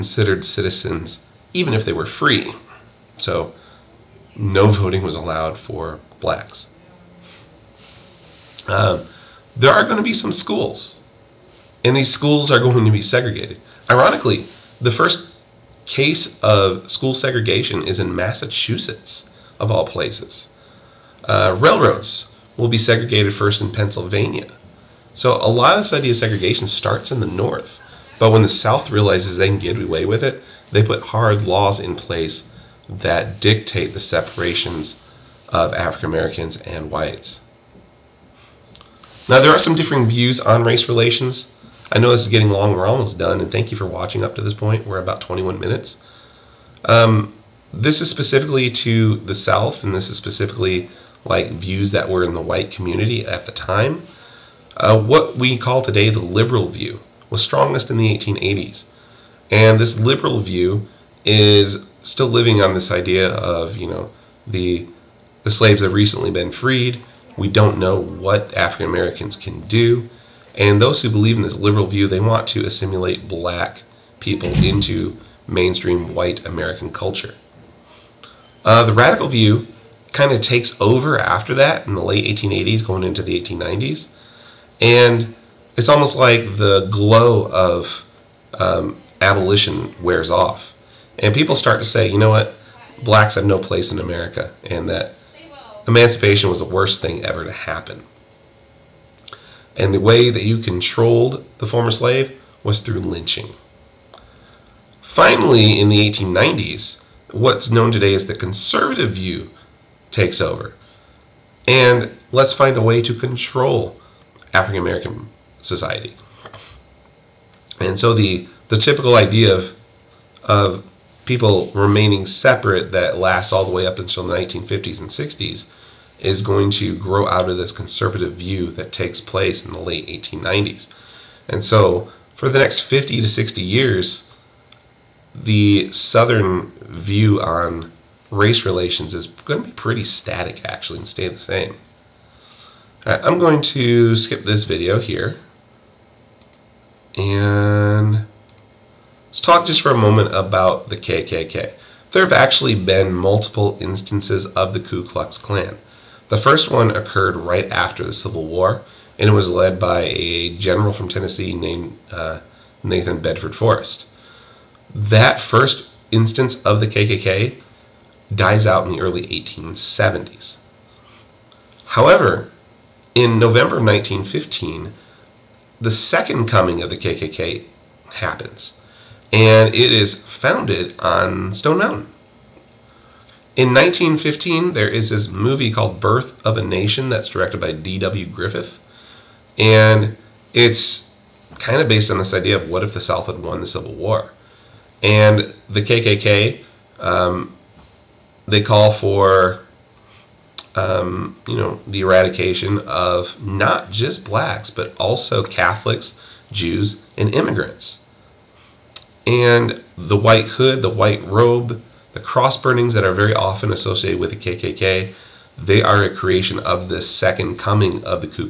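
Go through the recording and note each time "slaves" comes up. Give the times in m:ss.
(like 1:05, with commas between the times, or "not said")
1:05, 1:41.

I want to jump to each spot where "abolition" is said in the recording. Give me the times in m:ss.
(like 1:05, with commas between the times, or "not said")
1:29.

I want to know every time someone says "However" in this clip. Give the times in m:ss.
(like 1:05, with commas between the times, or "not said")
2:51.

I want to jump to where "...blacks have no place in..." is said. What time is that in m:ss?
1:33.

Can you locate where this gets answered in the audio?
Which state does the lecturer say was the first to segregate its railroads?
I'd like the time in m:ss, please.
0:23.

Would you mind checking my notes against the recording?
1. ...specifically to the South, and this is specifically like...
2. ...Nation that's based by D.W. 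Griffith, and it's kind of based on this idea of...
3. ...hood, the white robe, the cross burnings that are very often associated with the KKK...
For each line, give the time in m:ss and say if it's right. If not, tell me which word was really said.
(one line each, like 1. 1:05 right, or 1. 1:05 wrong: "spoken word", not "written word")
1. 0:48 right
2. 3:06 wrong: "directed", not "based"
3. 3:30 right.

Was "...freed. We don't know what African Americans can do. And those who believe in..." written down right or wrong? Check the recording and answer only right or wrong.
right.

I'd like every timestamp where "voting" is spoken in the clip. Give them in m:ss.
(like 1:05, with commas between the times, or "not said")
0:04.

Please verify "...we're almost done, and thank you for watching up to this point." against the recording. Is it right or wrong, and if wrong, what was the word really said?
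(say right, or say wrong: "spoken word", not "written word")
right.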